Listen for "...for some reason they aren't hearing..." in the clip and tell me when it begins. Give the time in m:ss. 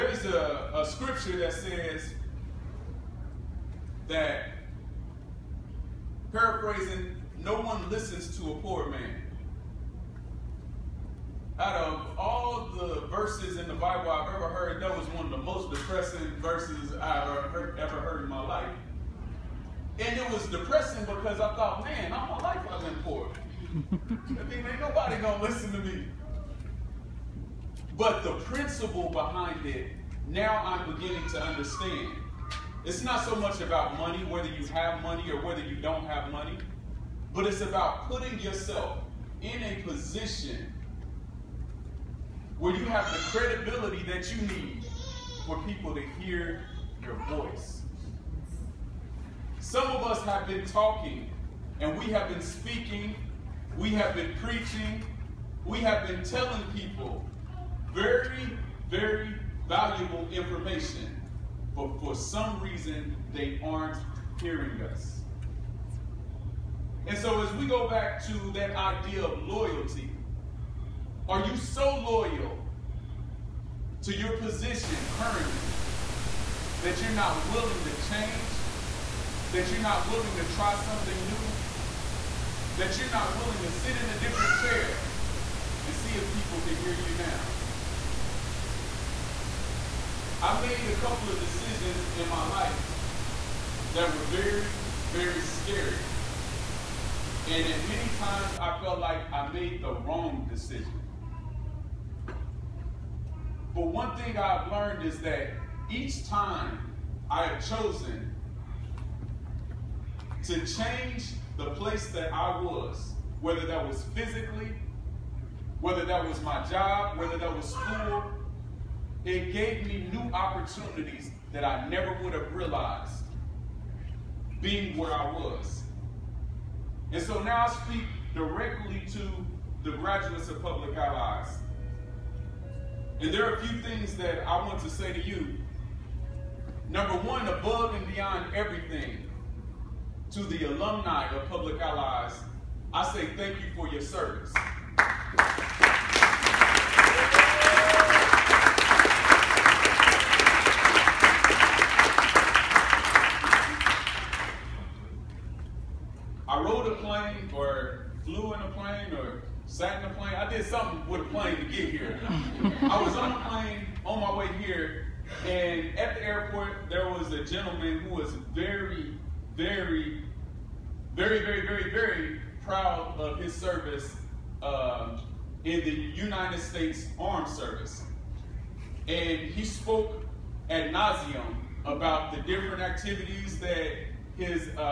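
1:02.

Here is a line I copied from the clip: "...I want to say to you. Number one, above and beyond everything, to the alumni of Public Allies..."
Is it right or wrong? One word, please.
right.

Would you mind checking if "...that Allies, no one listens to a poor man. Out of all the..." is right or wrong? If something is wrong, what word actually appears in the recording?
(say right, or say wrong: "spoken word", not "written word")
wrong: "Paraphrasing", not "Allies".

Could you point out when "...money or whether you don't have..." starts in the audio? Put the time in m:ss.
0:35.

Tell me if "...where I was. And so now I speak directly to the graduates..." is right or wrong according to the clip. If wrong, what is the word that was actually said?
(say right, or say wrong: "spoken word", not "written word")
right.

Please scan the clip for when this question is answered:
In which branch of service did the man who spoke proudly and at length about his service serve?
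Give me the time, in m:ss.
2:55.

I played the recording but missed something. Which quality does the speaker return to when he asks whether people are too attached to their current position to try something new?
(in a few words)
loyalty.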